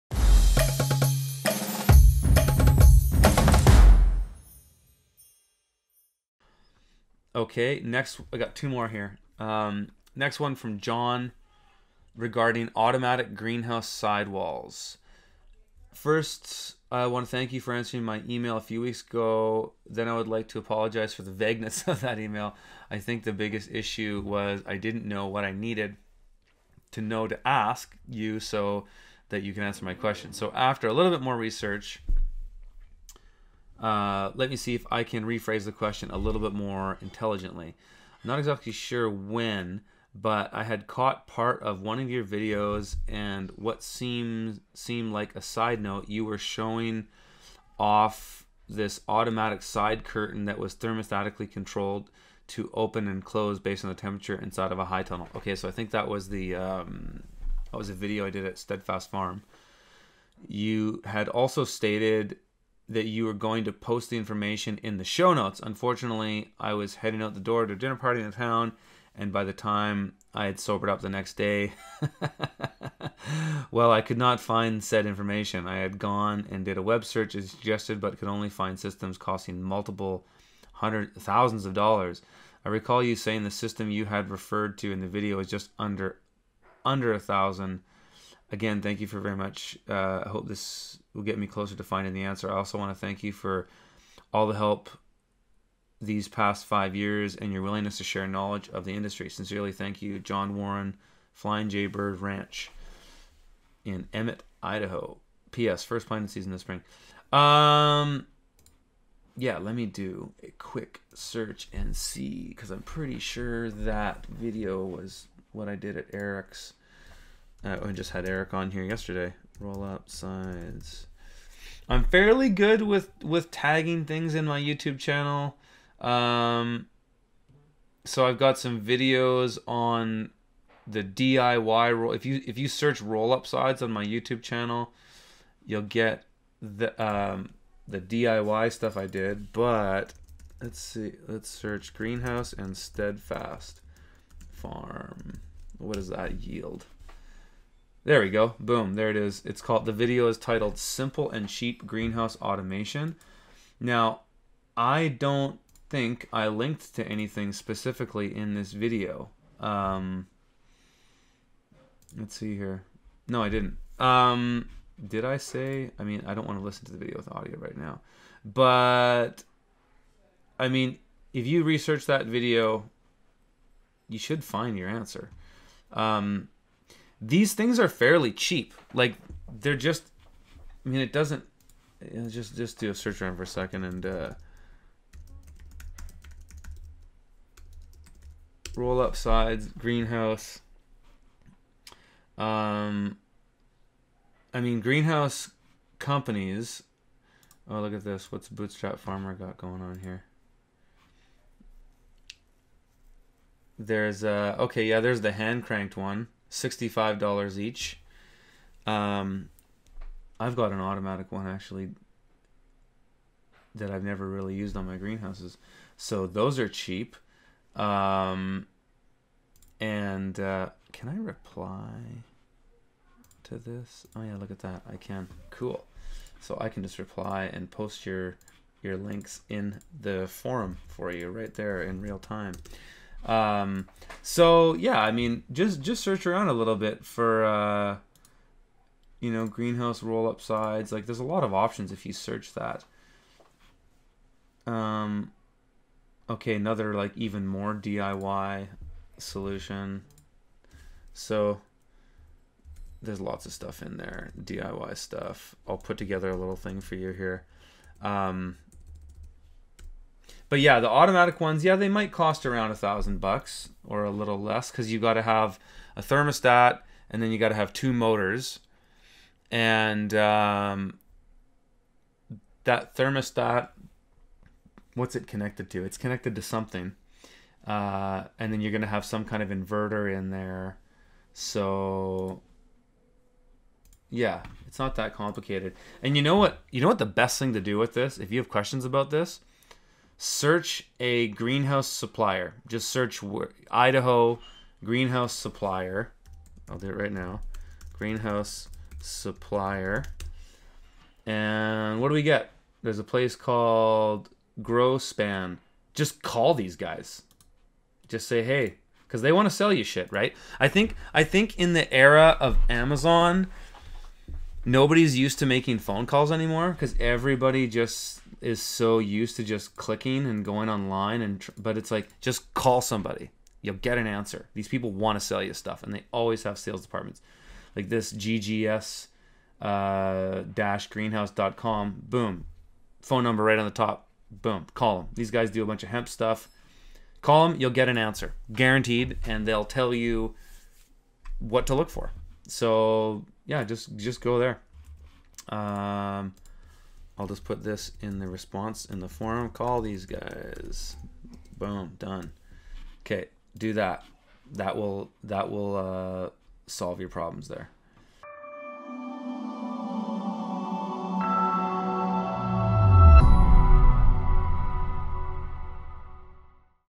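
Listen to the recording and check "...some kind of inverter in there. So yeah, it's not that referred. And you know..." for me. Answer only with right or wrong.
wrong.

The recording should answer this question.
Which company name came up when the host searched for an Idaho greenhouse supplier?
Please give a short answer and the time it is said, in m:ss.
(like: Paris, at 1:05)
Growspan, at 5:04.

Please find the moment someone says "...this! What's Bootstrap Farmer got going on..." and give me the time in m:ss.
3:18.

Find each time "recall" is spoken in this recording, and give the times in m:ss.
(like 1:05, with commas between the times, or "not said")
1:22.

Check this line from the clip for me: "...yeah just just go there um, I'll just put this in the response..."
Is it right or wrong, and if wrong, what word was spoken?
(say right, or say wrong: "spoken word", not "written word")
right.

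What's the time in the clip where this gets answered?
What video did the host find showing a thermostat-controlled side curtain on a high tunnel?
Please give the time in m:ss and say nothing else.
2:30.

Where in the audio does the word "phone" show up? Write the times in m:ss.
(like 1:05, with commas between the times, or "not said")
5:15, 5:32.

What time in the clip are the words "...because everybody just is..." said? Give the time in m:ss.
5:16.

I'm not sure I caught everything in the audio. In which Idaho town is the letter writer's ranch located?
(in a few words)
Emmett.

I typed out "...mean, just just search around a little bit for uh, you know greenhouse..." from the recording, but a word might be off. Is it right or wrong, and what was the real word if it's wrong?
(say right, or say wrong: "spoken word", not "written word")
right.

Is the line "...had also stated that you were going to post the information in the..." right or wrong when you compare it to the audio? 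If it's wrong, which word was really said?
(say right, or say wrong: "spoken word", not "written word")
right.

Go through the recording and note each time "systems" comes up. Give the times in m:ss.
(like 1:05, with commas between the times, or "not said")
1:18, 1:23.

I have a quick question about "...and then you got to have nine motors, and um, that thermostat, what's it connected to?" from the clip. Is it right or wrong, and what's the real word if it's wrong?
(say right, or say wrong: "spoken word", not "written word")
wrong: "two", not "nine".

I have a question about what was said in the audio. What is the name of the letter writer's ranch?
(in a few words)
Flying J Bird Ranch.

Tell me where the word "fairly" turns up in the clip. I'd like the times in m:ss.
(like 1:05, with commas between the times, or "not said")
2:02, 2:57.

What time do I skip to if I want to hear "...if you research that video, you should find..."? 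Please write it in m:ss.
2:51.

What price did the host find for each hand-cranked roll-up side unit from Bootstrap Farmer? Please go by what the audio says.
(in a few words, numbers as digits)
$65.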